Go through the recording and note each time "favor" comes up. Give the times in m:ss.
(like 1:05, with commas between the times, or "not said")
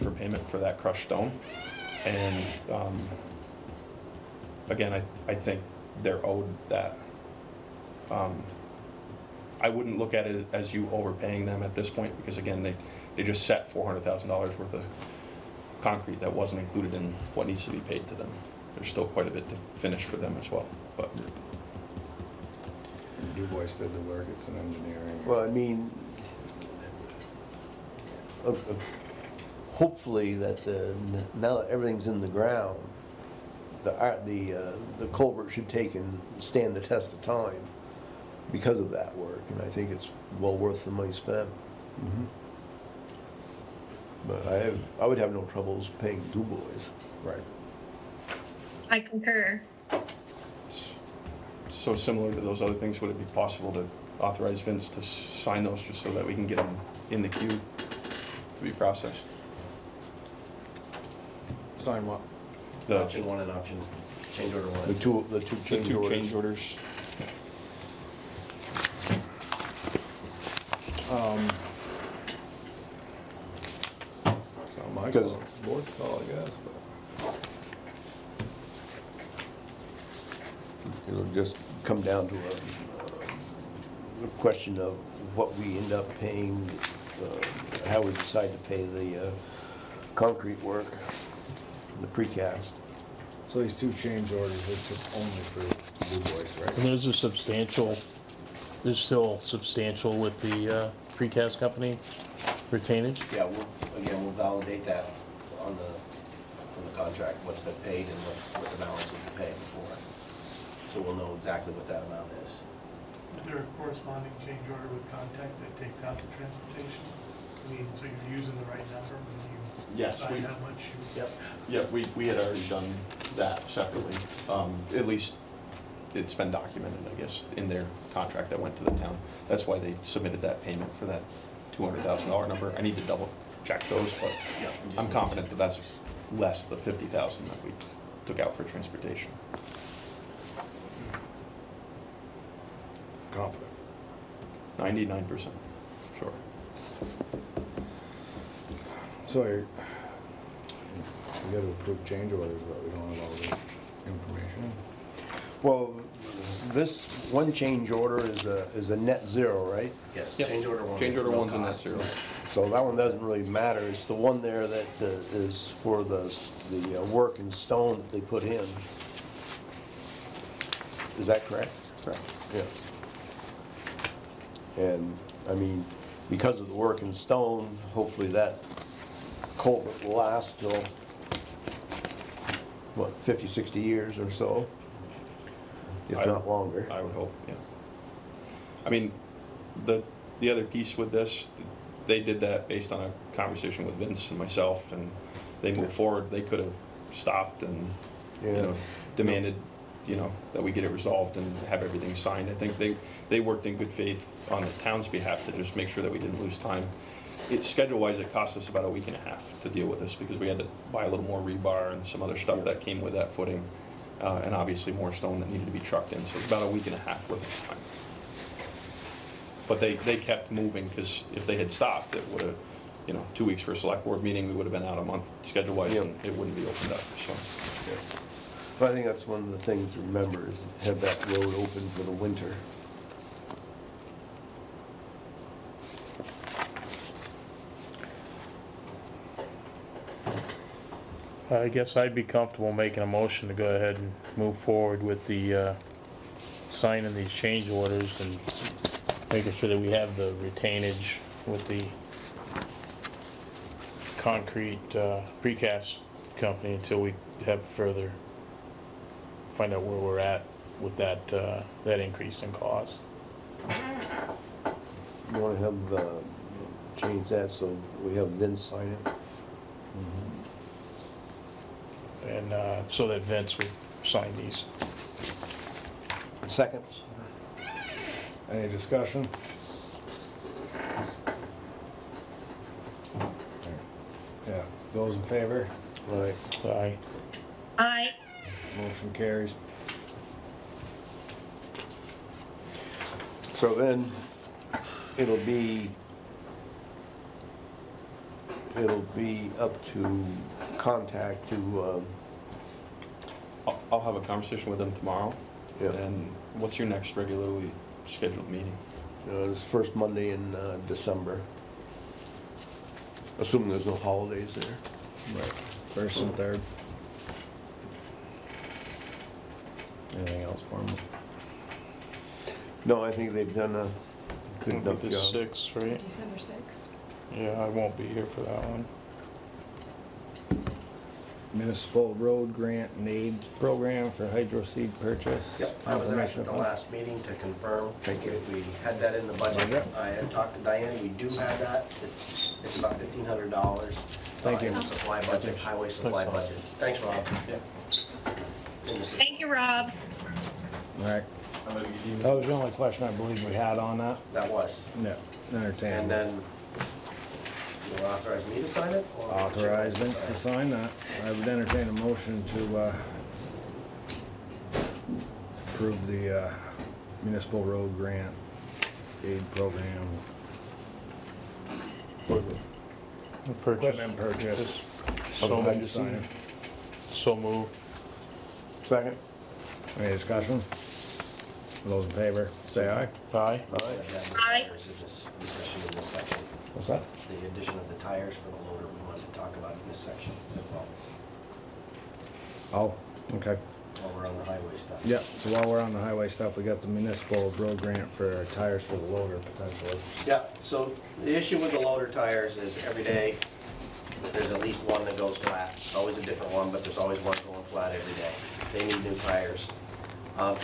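4:45, 6:22.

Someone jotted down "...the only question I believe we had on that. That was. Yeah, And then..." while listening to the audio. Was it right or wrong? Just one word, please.
right.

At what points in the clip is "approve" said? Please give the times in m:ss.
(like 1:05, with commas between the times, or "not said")
2:31, 6:05.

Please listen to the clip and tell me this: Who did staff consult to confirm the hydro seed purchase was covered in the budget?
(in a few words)
Diane.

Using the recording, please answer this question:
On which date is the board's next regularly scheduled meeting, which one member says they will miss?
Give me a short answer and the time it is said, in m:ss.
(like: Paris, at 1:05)
December 6, at 5:25.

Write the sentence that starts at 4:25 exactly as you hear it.
You wanna have, change that so we have Vince sign it?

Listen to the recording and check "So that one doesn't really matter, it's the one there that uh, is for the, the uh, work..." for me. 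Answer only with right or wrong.
right.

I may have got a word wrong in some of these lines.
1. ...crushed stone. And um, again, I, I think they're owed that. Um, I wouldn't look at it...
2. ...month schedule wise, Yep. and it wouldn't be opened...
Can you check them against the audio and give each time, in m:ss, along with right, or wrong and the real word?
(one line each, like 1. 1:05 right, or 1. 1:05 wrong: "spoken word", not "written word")
1. 0:00 right
2. 3:45 right.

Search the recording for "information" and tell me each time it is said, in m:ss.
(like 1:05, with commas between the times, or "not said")
2:34.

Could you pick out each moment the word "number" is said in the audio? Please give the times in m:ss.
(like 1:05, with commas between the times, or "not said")
1:58, 2:12.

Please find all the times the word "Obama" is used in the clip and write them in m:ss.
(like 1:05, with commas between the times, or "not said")
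not said.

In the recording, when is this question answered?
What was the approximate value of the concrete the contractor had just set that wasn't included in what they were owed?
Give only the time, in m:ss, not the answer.
0:13.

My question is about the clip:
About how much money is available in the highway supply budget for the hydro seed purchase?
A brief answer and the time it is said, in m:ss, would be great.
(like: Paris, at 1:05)
$1,500, at 5:42.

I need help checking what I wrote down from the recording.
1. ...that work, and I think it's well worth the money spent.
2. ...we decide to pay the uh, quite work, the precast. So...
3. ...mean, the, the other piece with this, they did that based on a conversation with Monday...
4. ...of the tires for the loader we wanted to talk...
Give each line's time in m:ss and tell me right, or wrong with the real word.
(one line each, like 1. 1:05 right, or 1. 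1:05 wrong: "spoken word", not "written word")
1. 0:38 right
2. 1:28 wrong: "concrete", not "quite"
3. 3:08 wrong: "Vince", not "Monday"
4. 6:27 right.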